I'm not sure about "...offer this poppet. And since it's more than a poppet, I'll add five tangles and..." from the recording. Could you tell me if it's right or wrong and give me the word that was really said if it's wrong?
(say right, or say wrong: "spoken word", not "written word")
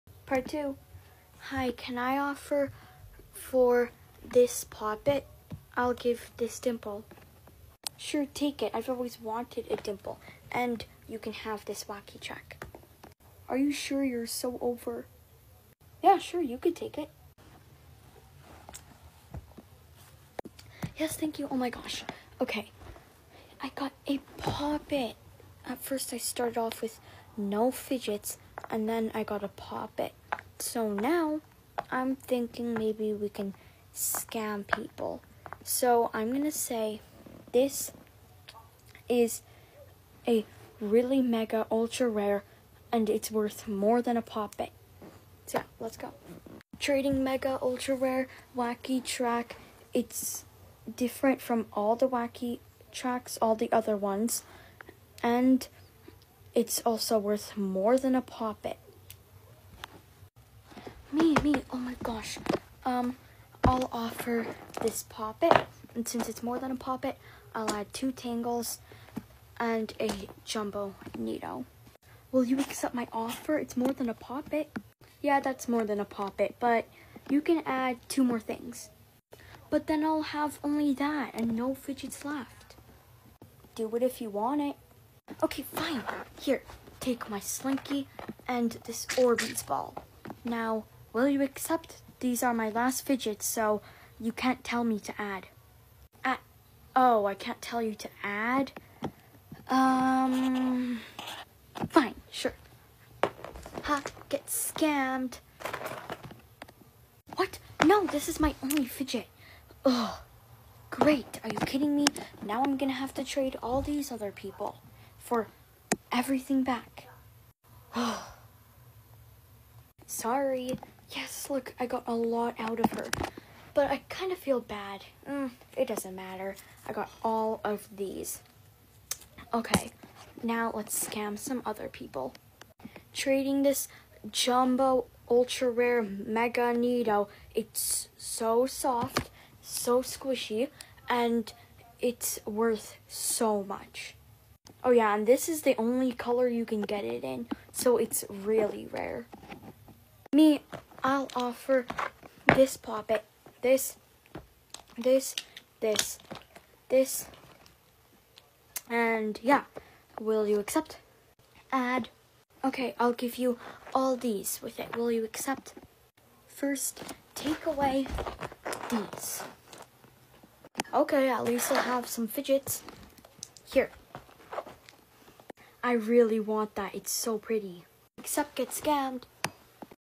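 wrong: "two", not "five".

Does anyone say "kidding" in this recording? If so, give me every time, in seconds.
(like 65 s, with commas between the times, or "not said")
111 s.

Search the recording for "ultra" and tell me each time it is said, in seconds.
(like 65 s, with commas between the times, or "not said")
41 s, 47 s, 135 s.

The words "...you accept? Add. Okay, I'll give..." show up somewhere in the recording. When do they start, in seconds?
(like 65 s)
160 s.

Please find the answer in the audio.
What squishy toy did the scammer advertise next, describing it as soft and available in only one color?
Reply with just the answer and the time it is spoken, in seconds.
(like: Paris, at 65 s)
NeeDoh, at 136 s.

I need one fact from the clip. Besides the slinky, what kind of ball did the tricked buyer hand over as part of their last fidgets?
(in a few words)
Orbeez ball.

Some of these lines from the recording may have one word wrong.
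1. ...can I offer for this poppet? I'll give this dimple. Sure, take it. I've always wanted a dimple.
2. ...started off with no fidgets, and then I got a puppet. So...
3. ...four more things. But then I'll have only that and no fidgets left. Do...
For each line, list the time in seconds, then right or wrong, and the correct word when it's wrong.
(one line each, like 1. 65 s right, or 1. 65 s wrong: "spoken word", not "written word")
1. 1 s right
2. 26 s wrong: "poppet", not "puppet"
3. 78 s wrong: "two", not "four".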